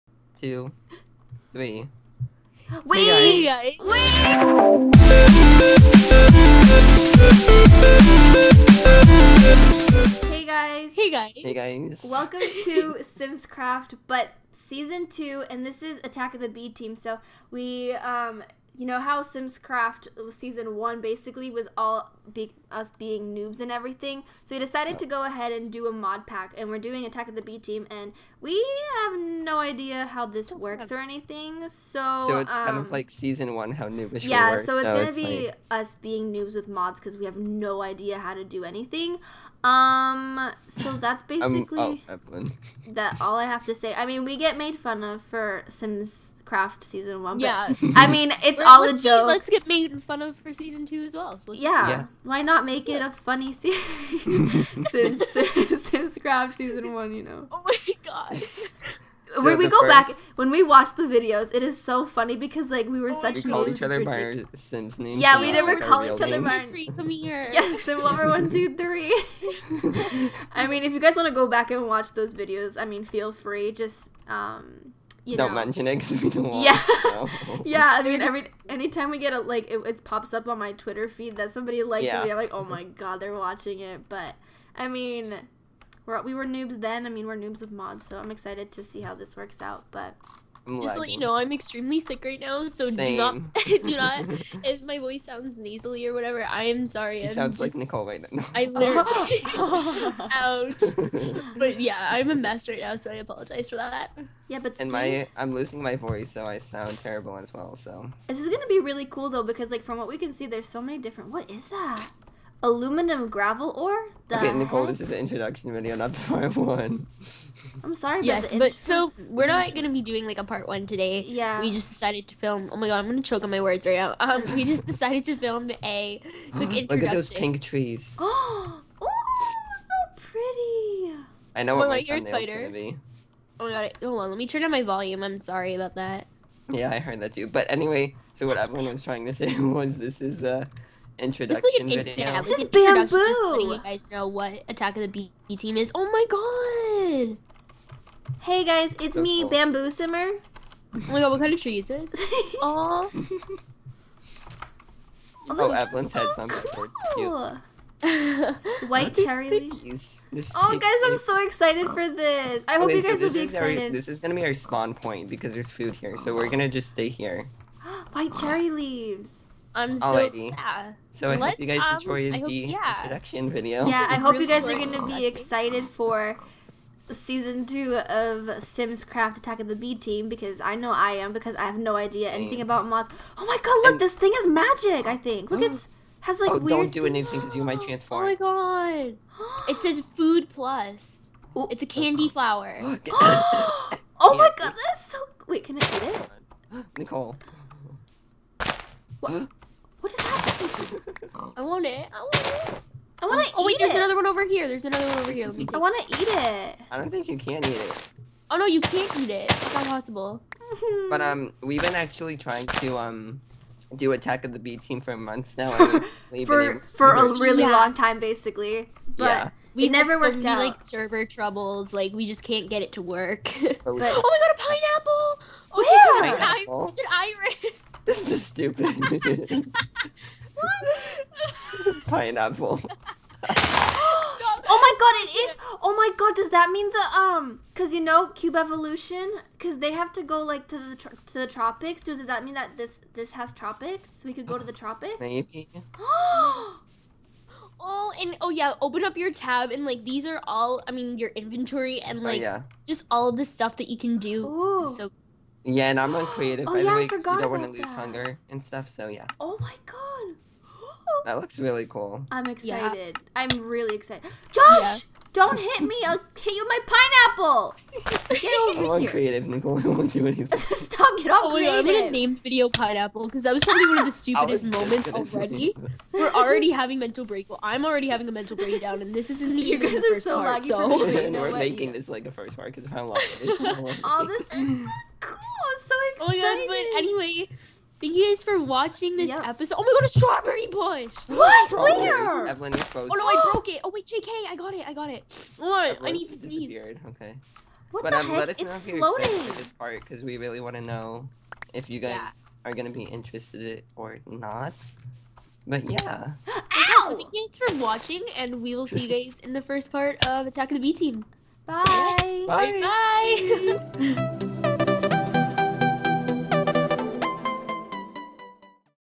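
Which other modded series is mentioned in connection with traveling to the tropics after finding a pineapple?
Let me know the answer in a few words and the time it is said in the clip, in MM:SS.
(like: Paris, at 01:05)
Cube Evolution, at 03:58.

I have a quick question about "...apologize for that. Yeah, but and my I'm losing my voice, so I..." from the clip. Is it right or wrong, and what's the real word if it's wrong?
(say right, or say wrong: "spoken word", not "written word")
right.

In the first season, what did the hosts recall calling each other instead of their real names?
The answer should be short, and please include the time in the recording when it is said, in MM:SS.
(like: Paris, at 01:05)
Sims names, at 01:04.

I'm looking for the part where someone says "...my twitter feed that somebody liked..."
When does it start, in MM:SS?
01:20.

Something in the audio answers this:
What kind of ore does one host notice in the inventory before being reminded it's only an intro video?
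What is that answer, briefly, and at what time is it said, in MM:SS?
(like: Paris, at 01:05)
Aluminum gravel ore, at 01:52.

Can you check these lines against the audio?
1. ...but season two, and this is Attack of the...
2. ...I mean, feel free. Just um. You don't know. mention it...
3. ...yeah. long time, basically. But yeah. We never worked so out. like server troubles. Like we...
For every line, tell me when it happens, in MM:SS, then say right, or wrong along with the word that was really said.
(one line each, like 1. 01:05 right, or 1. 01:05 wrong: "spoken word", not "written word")
1. 00:14 right
2. 01:12 right
3. 03:37 right.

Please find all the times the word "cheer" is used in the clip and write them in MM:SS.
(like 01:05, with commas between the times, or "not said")
not said.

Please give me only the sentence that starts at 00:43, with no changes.
I mean, we get made fun of for Simscraft season one, yeah.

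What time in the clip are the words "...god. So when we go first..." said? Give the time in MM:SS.
00:58.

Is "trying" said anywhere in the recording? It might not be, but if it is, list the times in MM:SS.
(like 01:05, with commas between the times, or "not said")
02:19, 03:32.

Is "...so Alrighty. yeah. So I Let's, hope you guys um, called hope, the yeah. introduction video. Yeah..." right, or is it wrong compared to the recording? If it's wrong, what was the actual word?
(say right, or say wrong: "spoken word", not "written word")
wrong: "enjoyed", not "called".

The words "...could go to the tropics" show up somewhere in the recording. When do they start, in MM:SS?
04:04.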